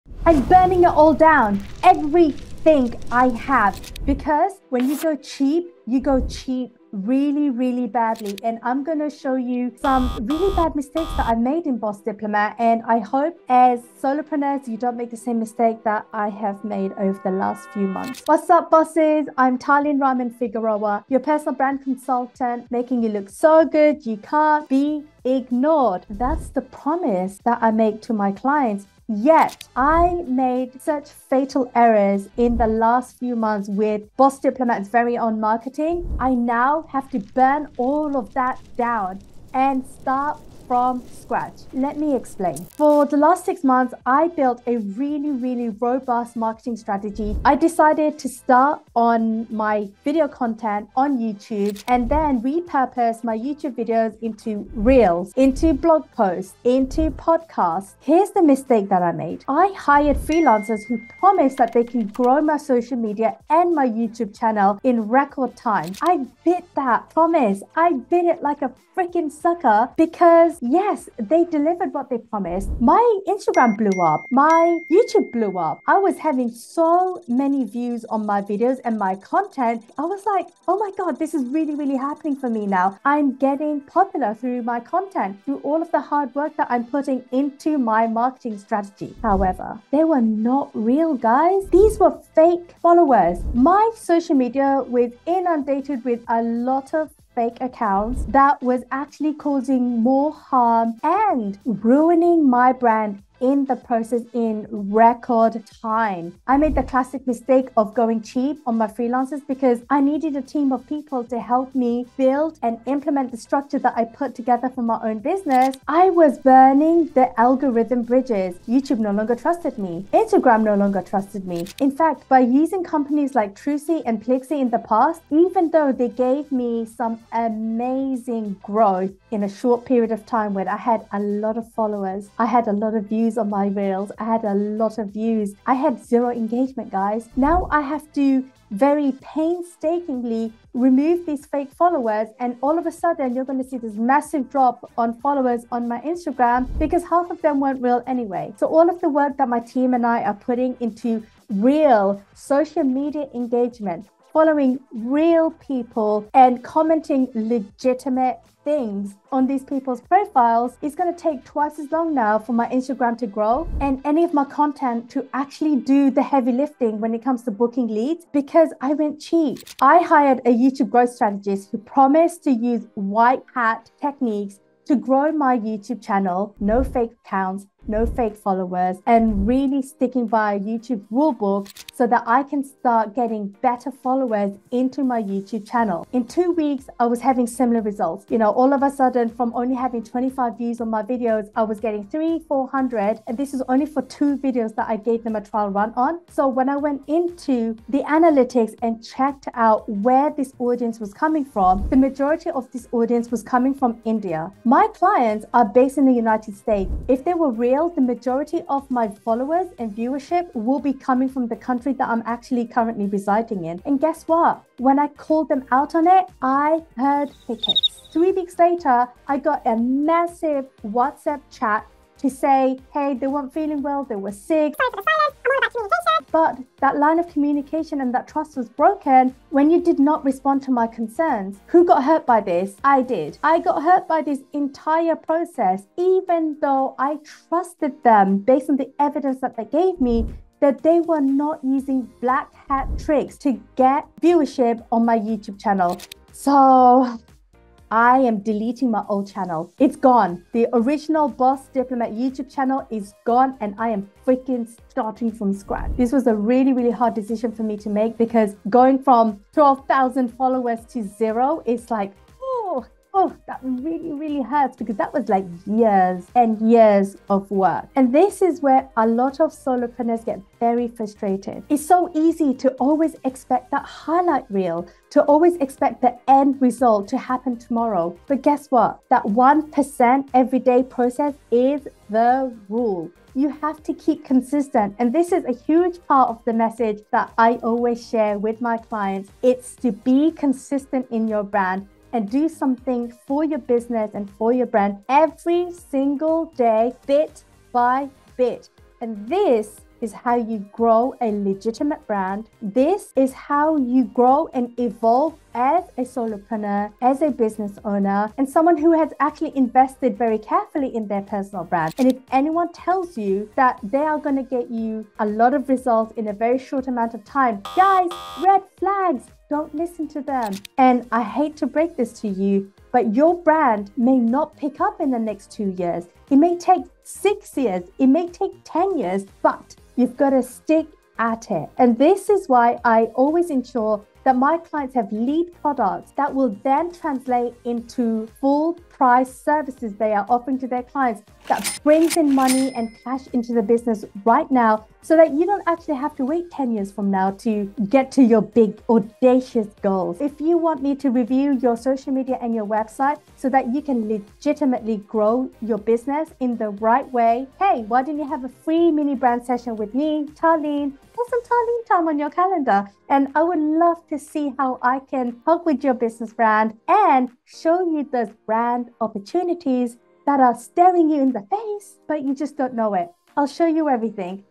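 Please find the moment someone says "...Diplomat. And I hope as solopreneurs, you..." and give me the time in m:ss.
0:12.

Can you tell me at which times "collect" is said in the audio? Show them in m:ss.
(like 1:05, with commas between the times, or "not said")
not said.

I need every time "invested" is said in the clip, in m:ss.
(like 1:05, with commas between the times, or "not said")
5:09.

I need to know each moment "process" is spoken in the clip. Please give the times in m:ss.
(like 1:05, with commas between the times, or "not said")
1:43, 3:55, 4:40.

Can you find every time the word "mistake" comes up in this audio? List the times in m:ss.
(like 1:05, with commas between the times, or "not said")
0:10, 0:15, 0:58, 1:47.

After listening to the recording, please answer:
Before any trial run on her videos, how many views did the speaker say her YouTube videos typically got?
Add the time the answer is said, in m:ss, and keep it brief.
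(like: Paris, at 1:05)
25, at 3:10.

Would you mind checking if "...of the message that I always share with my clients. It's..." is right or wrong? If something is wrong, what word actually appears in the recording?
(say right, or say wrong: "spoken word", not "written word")
right.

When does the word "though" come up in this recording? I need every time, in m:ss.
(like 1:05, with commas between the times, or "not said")
2:05, 3:56.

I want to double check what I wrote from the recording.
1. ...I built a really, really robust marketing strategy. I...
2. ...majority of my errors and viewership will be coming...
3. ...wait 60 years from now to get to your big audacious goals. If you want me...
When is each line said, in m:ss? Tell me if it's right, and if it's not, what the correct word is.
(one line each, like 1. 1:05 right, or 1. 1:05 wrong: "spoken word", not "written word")
1. 0:44 right
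2. 3:28 wrong: "followers", not "errors"
3. 5:46 wrong: "10", not "60".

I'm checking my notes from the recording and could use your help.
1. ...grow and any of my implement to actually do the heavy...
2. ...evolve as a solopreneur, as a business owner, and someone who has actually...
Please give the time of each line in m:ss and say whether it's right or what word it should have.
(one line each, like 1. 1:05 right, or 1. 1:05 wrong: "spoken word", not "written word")
1. 2:43 wrong: "content", not "implement"
2. 5:04 right.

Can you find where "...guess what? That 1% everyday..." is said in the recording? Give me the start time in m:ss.
4:38.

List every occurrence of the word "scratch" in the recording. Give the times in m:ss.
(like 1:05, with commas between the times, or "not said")
0:41, 4:15.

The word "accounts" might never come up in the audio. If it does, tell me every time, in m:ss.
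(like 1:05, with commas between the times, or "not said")
1:37, 2:57.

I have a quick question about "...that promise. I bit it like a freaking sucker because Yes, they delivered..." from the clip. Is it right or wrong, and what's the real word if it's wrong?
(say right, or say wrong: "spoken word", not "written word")
right.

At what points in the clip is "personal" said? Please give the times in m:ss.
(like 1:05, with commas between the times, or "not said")
0:21, 5:11.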